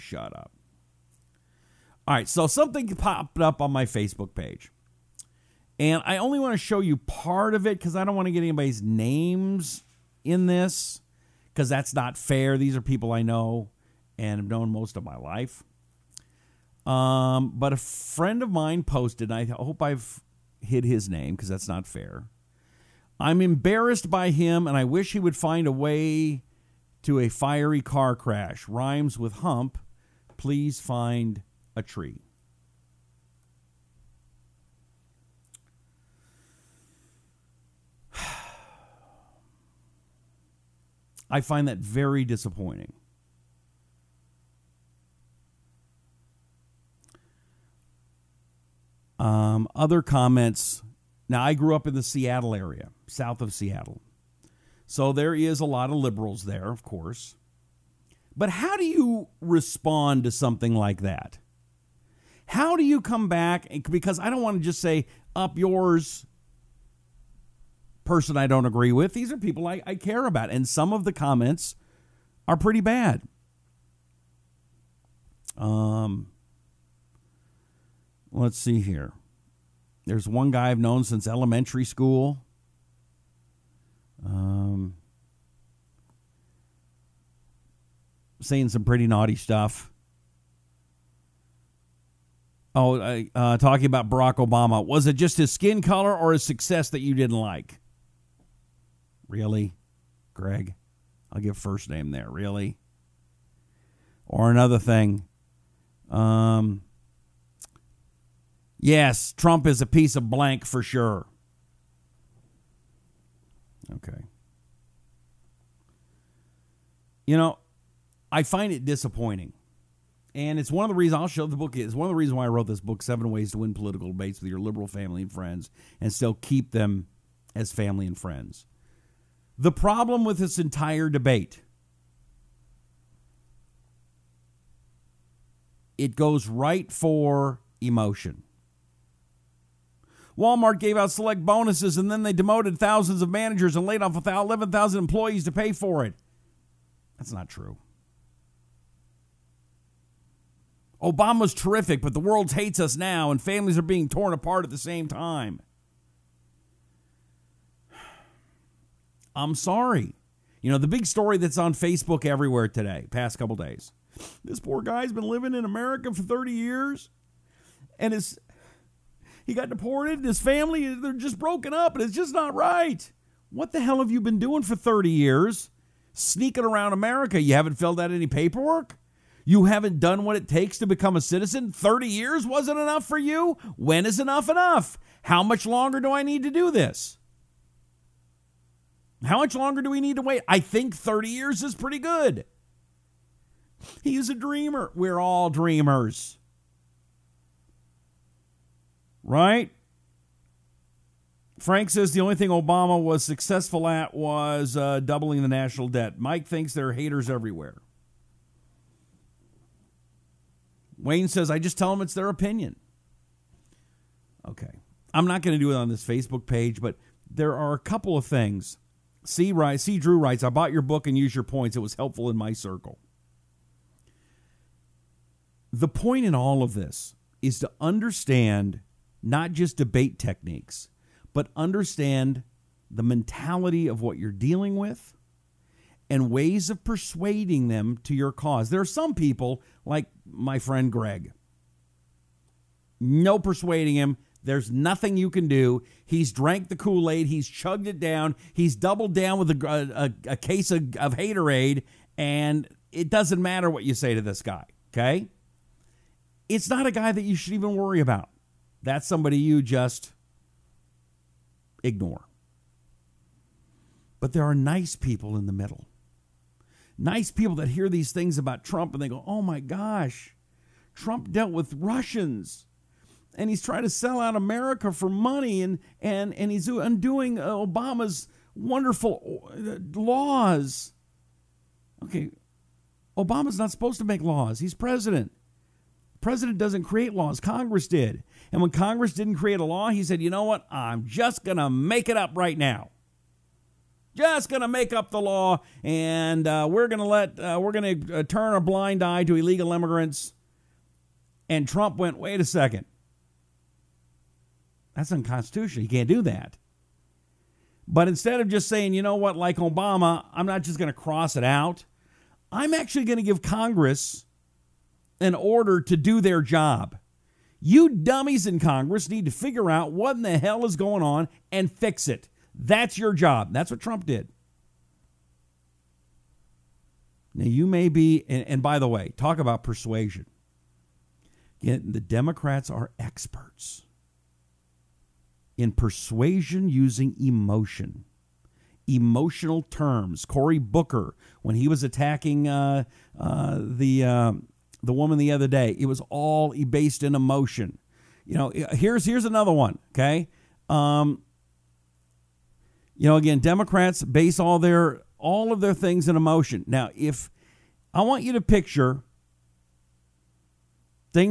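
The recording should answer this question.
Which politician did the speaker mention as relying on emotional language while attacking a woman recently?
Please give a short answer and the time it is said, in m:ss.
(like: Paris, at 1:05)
Cory Booker, at 5:40.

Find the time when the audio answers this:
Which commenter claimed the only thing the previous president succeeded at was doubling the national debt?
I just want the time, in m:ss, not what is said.
3:21.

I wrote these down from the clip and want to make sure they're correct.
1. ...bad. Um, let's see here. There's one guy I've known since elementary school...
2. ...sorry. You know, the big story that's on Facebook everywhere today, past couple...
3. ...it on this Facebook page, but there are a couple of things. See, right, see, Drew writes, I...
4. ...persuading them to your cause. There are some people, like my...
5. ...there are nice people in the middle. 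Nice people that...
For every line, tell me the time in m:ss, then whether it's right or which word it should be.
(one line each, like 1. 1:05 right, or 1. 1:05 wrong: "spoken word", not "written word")
1. 1:12 right
2. 2:39 right
3. 3:35 right
4. 3:56 right
5. 4:24 right.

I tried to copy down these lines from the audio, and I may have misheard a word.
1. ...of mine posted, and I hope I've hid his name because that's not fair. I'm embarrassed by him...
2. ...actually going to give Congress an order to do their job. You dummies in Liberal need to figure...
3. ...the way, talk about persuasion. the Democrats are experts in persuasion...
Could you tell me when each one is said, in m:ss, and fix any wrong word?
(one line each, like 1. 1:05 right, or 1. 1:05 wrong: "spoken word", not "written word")
1. 0:18 right
2. 5:12 wrong: "Congress", not "Liberal"
3. 5:28 right.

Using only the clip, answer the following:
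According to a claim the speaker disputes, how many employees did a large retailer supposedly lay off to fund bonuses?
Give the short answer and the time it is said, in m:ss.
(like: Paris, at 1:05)
11,000, at 2:24.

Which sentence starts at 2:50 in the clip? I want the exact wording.
His family, they're just broken up, and it's just not right.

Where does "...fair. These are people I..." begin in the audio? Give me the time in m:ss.
0:12.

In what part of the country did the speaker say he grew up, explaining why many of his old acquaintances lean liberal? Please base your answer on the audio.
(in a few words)
South of Seattle.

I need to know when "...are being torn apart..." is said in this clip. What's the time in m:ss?
2:33.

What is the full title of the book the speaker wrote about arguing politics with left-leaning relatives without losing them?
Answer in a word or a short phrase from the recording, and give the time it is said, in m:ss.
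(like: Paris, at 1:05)
Seven Ways to Win Political Debates, at 2:03.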